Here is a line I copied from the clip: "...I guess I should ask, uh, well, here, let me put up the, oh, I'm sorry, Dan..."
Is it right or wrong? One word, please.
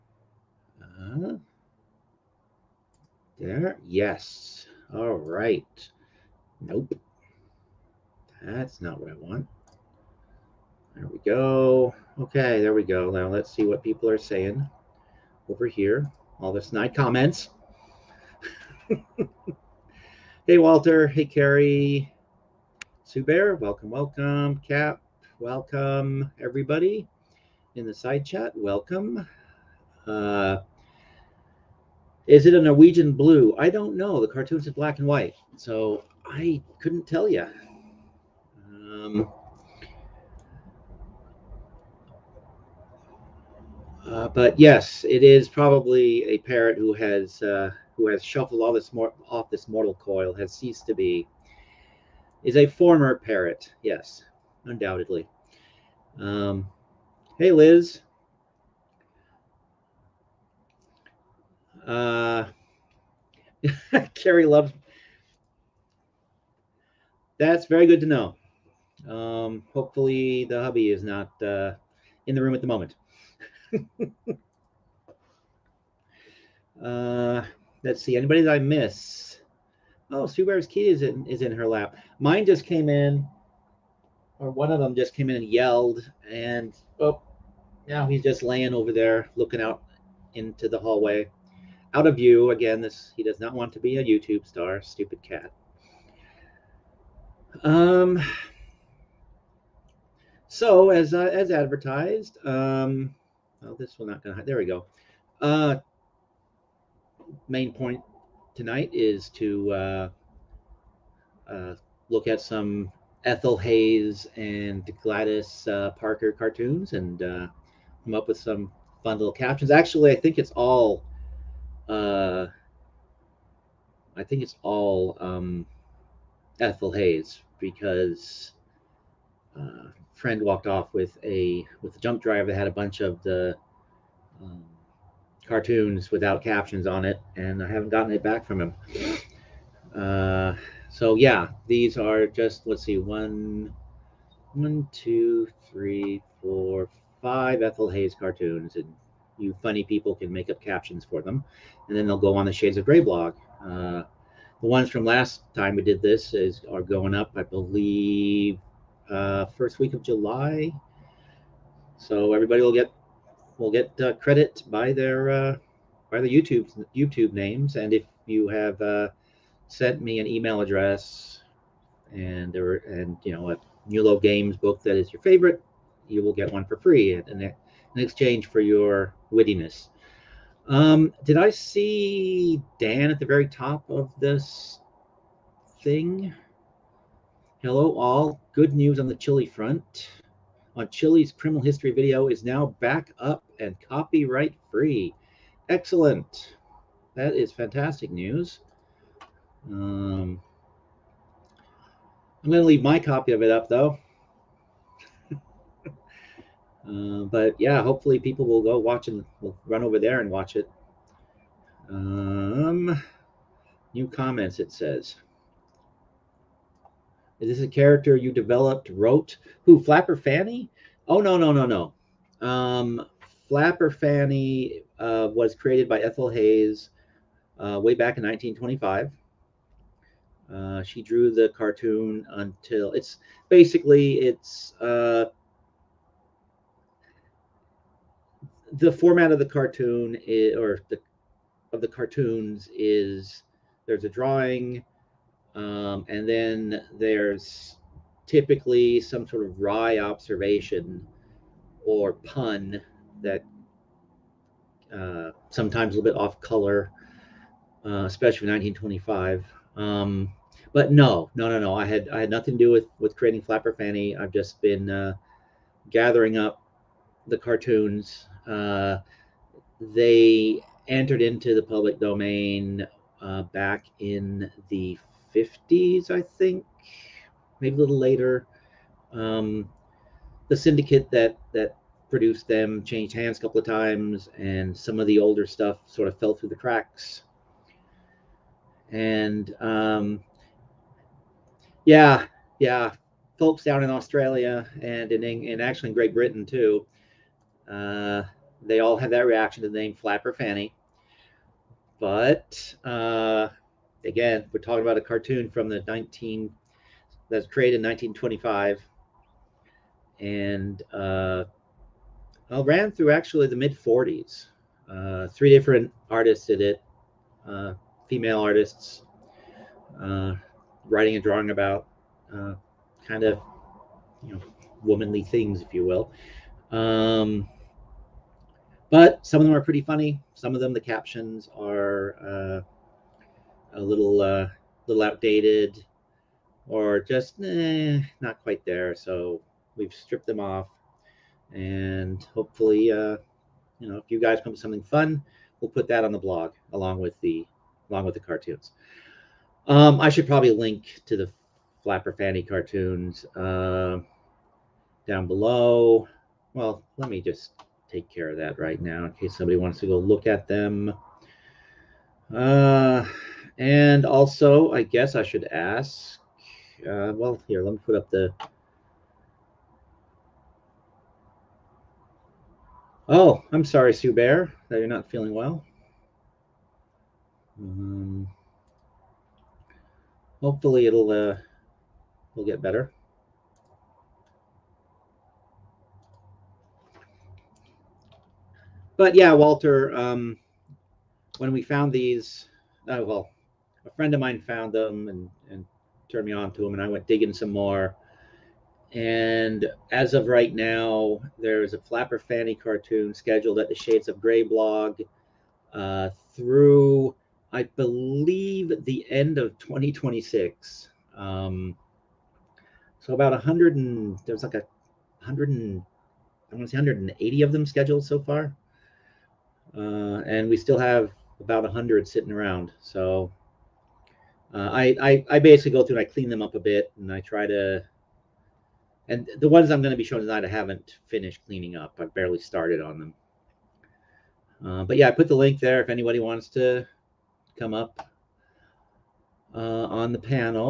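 wrong.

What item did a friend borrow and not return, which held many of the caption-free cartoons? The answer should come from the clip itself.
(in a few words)
a jump drive.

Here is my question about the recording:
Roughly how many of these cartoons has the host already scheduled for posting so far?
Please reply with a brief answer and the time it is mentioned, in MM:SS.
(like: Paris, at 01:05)
180, at 06:56.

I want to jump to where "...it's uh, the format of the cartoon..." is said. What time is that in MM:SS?
03:54.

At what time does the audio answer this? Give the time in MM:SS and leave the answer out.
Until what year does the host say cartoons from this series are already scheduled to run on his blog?
06:49.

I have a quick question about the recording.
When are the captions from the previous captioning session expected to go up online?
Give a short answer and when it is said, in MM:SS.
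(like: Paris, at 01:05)
first week of July, at 02:39.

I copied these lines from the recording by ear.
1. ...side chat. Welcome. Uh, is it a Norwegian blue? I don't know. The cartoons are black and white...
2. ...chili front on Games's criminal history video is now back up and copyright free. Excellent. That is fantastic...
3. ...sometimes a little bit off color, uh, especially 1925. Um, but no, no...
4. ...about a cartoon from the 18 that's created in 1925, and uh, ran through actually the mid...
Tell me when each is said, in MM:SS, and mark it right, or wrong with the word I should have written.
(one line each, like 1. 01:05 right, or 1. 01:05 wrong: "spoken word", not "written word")
1. 00:27 right
2. 03:09 wrong: "Chile", not "Games"
3. 04:15 right
4. 05:04 wrong: "19", not "18".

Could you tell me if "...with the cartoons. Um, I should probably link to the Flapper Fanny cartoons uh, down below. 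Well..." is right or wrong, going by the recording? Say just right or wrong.
right.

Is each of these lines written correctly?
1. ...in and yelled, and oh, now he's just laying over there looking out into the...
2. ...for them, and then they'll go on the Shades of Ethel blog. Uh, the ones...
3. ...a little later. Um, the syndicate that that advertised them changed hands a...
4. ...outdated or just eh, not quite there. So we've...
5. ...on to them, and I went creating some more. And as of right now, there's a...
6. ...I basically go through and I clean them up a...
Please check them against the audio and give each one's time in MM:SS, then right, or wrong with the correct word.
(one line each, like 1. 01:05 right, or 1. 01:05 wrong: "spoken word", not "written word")
1. 01:25 right
2. 02:31 wrong: "Gray", not "Ethel"
3. 04:37 wrong: "produced", not "advertised"
4. 05:35 right
5. 06:36 wrong: "digging", not "creating"
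6. 07:05 right.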